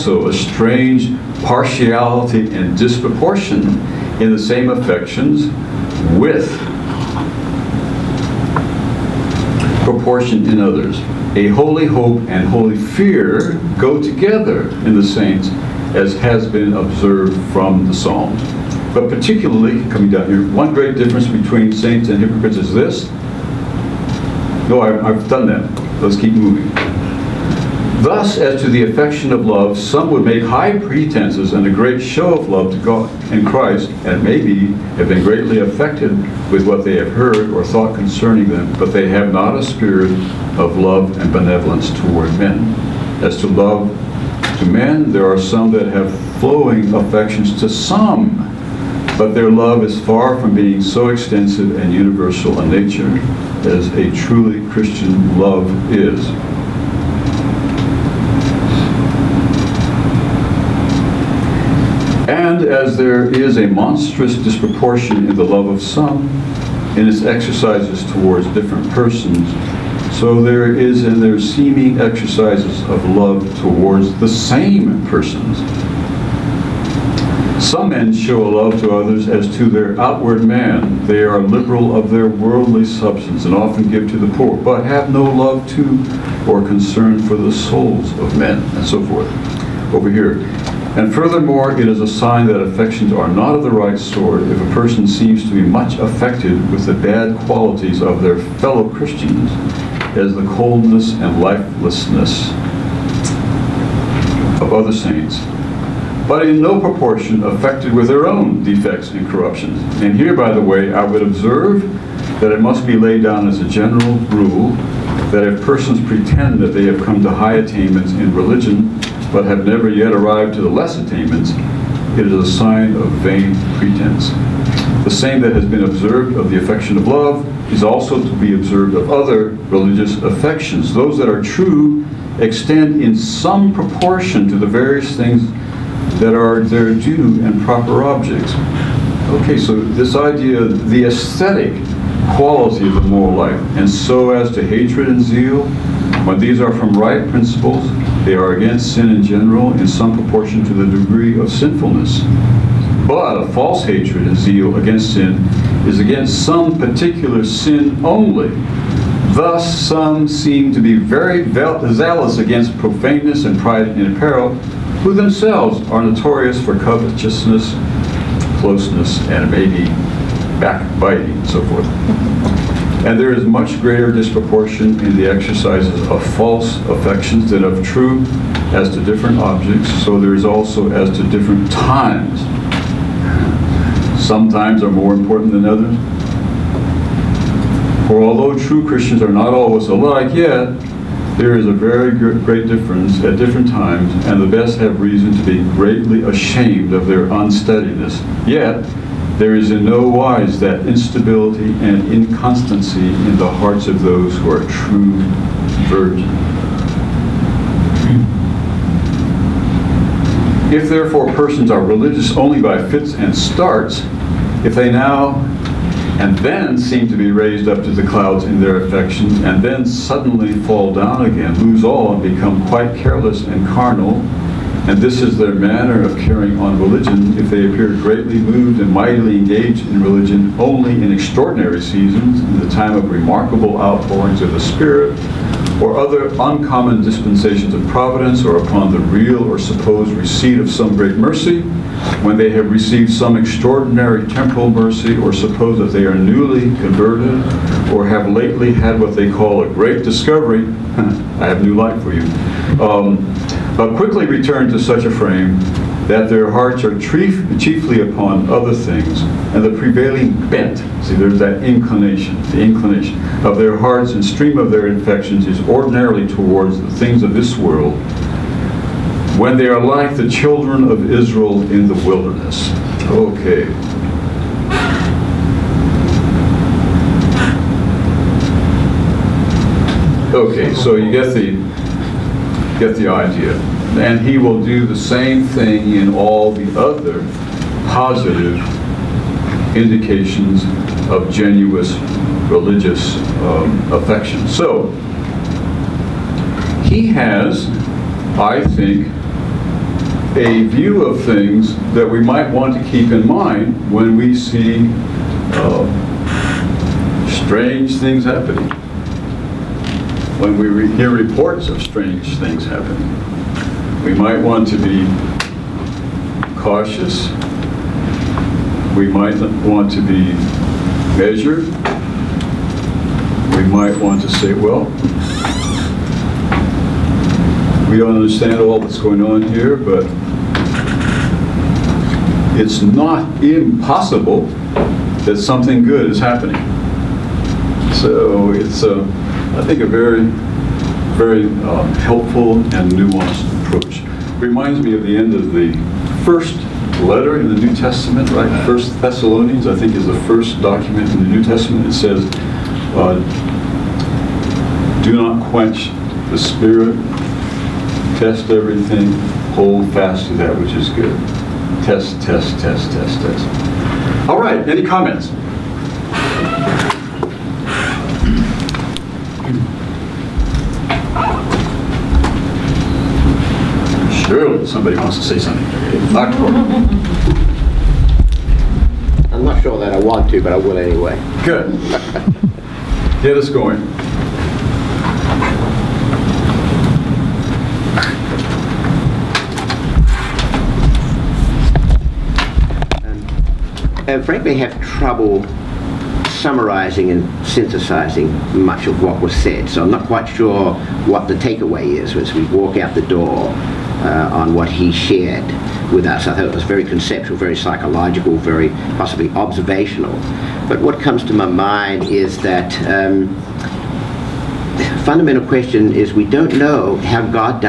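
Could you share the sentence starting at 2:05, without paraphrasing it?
The same that has been observed of the affection of love is also to be observed of other religious affections.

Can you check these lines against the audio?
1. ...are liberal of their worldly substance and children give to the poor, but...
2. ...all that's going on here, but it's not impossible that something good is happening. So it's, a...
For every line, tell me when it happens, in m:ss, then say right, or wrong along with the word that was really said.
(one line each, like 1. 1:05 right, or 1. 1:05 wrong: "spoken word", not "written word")
1. 1:21 wrong: "often", not "children"
2. 5:28 right.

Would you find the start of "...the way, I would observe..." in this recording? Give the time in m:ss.
1:50.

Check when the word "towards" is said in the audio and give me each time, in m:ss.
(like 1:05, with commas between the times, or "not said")
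0:41, 1:08, 1:13, 4:26.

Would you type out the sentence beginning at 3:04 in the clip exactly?
Some times are more important than others.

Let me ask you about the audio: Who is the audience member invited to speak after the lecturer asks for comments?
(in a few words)
Dr. Corbin.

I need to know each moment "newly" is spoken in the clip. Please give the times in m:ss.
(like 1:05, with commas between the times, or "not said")
4:06.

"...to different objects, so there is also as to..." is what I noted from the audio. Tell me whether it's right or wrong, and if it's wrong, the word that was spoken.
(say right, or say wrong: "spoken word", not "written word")
right.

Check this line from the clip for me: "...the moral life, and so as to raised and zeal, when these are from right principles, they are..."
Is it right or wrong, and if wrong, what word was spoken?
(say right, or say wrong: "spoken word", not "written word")
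wrong: "hatred", not "raised".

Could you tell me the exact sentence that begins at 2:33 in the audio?
But a false hatred and zeal against sin is against some particular sin only.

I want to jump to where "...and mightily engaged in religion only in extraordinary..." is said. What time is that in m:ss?
3:48.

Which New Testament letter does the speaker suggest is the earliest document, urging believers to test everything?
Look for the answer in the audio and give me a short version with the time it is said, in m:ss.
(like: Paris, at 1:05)
First Thessalonians, at 5:48.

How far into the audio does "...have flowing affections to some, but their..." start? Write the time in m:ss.
0:45.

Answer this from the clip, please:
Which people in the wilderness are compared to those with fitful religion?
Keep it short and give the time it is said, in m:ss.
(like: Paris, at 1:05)
Children of Israel, at 4:30.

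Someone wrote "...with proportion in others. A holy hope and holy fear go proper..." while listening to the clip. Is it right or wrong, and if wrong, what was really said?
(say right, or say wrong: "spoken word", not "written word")
wrong: "together", not "proper".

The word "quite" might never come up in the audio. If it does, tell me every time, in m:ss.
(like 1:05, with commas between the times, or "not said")
3:42, 6:40.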